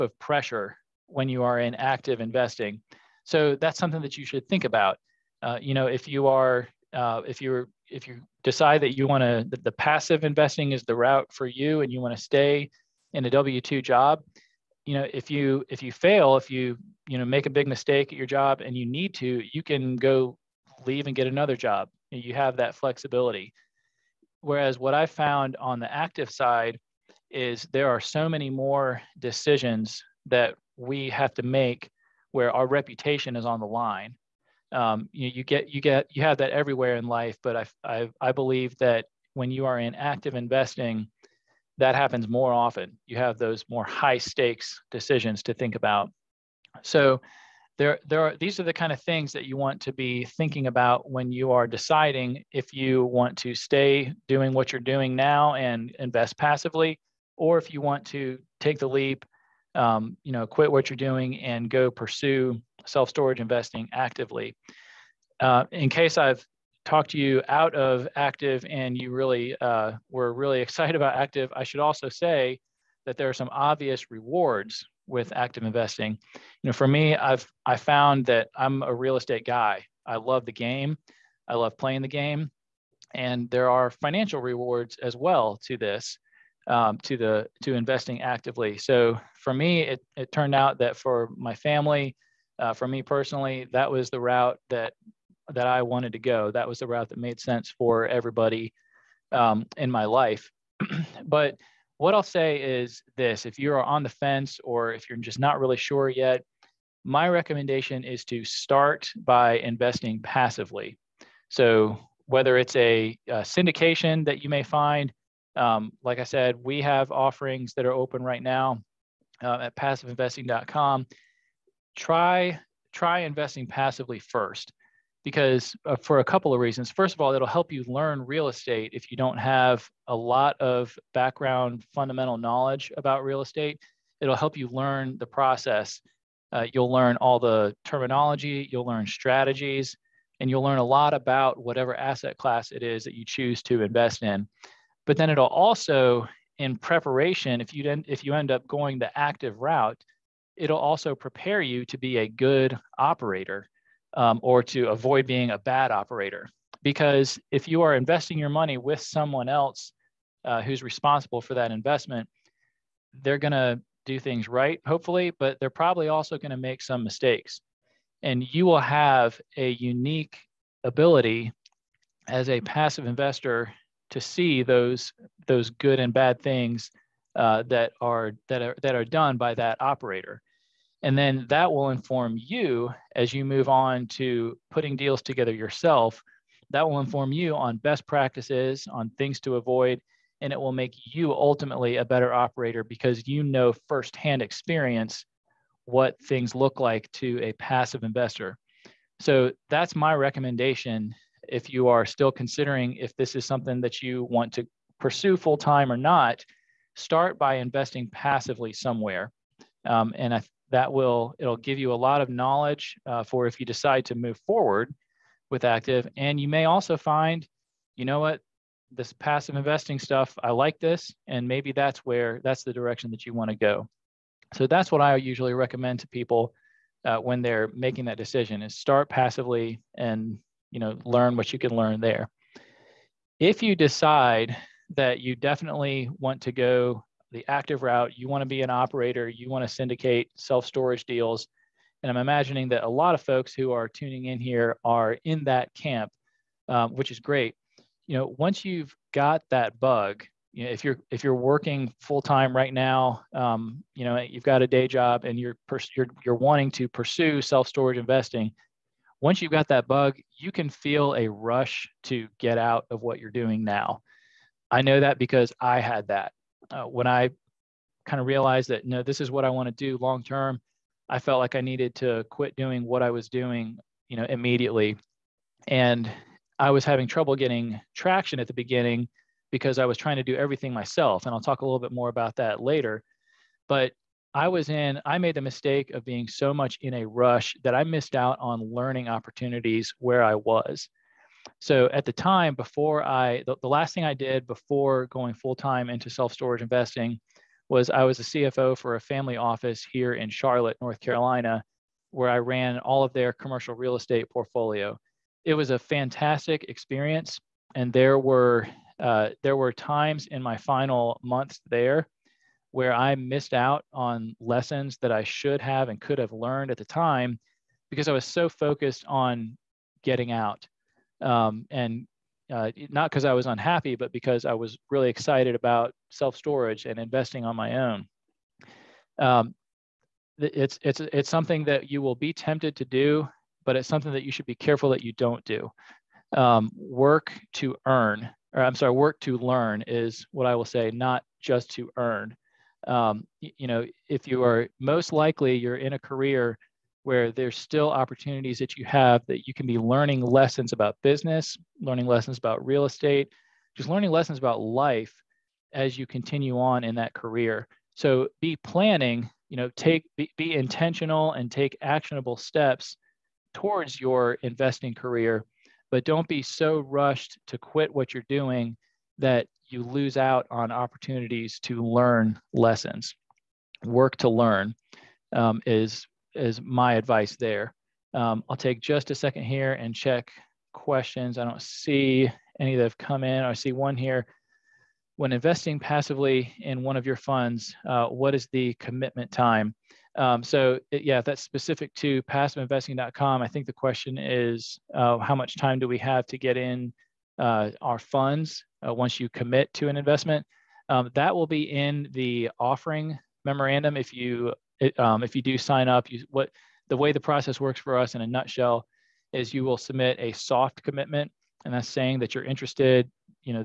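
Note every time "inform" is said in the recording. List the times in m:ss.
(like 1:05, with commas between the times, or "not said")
3:01, 3:06.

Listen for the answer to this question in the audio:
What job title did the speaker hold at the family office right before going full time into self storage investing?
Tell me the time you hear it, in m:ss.
4:58.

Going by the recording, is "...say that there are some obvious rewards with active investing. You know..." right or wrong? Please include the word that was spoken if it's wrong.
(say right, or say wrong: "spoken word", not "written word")
right.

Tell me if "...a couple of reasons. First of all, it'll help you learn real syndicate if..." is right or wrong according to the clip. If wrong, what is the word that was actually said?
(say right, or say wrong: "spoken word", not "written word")
wrong: "estate", not "syndicate".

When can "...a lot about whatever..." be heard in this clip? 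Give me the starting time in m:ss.
2:20.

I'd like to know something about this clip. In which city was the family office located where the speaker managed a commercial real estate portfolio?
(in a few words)
Charlotte, North Carolina.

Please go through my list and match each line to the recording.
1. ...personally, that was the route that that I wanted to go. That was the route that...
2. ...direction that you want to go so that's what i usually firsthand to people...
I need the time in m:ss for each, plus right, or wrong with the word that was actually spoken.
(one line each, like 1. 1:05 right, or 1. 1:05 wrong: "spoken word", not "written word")
1. 1:33 right
2. 3:42 wrong: "recommend", not "firsthand".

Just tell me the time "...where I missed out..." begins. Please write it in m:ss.
5:12.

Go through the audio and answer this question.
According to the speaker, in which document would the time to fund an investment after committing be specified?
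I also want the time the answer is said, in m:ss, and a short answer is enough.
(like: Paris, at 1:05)
offering memorandum, at 6:42.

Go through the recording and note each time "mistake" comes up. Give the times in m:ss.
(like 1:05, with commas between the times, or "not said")
0:17, 2:47, 4:45.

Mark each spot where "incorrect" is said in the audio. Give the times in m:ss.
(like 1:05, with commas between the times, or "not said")
not said.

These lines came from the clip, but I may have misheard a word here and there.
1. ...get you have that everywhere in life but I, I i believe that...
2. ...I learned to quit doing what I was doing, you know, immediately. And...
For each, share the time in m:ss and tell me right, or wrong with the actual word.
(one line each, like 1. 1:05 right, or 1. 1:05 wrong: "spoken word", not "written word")
1. 0:35 right
2. 4:31 wrong: "needed", not "learned".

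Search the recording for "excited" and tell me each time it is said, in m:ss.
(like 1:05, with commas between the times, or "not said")
1:10, 5:25.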